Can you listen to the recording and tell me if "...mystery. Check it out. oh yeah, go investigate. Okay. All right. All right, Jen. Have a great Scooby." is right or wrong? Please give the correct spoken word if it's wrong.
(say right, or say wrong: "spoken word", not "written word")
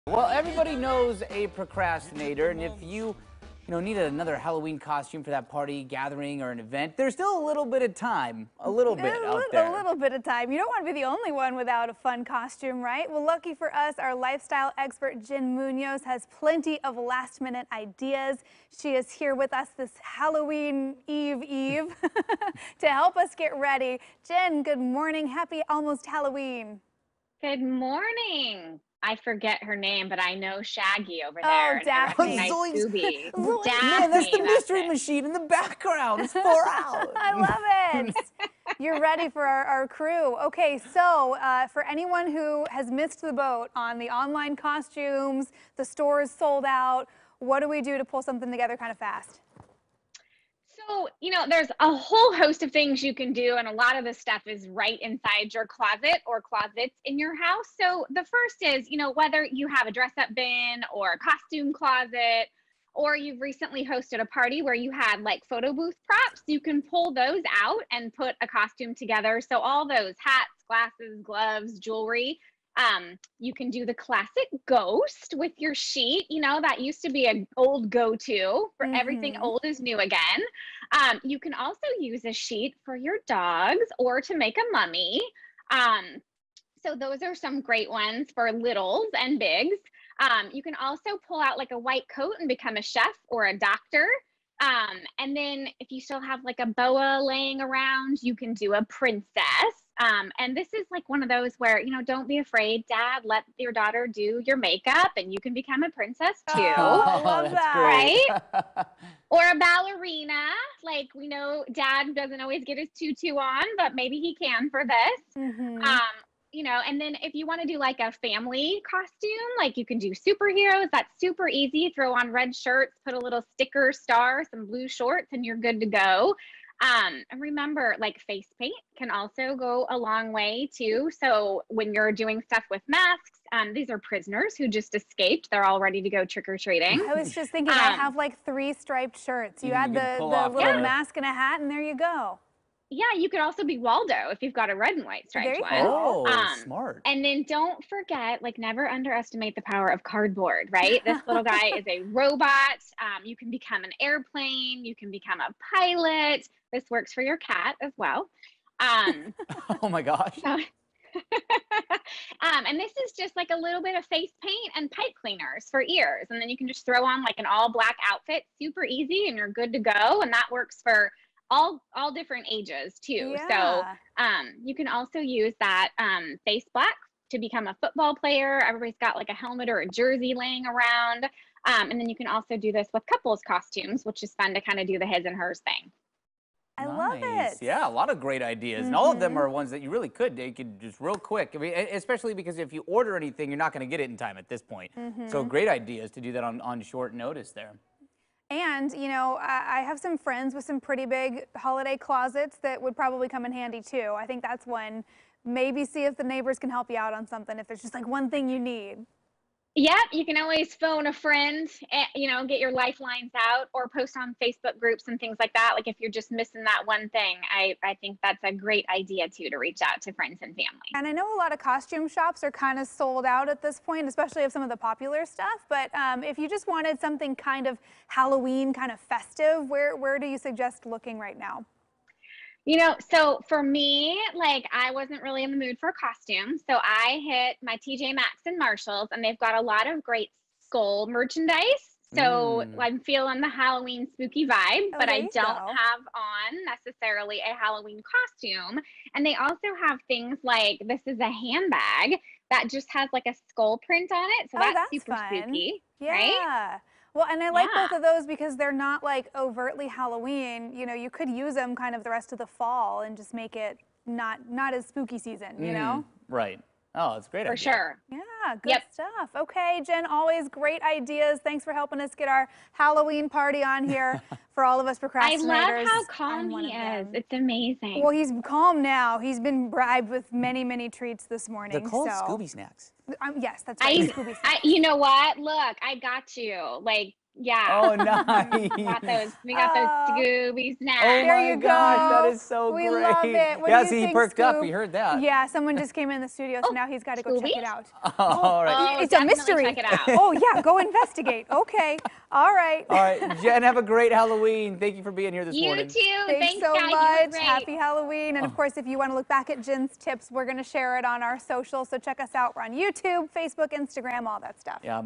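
wrong: "Halloween", not "Scooby".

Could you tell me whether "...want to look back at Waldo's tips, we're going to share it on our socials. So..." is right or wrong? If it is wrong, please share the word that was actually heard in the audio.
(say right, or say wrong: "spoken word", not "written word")
wrong: "Jen", not "Waldo".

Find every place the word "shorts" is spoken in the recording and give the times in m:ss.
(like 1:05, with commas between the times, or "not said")
2:04, 3:16.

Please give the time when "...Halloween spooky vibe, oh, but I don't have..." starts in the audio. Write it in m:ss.
4:03.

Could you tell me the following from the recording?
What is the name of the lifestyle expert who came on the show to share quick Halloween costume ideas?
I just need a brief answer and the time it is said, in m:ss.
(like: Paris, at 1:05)
Jen Munoz, at 0:15.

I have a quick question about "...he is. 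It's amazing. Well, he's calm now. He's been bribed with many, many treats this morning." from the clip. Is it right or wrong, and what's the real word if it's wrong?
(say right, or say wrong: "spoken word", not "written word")
right.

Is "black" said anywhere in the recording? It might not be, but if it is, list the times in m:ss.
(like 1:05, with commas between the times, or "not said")
2:47, 2:56.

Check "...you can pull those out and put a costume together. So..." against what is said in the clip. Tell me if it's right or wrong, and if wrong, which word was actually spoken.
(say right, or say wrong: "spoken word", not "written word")
right.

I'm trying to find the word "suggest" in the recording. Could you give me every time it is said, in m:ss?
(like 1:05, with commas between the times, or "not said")
3:50.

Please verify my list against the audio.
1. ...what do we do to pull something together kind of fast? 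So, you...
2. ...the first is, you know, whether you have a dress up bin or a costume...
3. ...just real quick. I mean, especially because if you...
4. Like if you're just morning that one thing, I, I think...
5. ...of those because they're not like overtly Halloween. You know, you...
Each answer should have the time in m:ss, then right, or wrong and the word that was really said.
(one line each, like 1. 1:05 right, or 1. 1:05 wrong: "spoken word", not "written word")
1. 0:47 right
2. 0:58 right
3. 3:10 right
4. 3:35 wrong: "missing", not "morning"
5. 4:17 right.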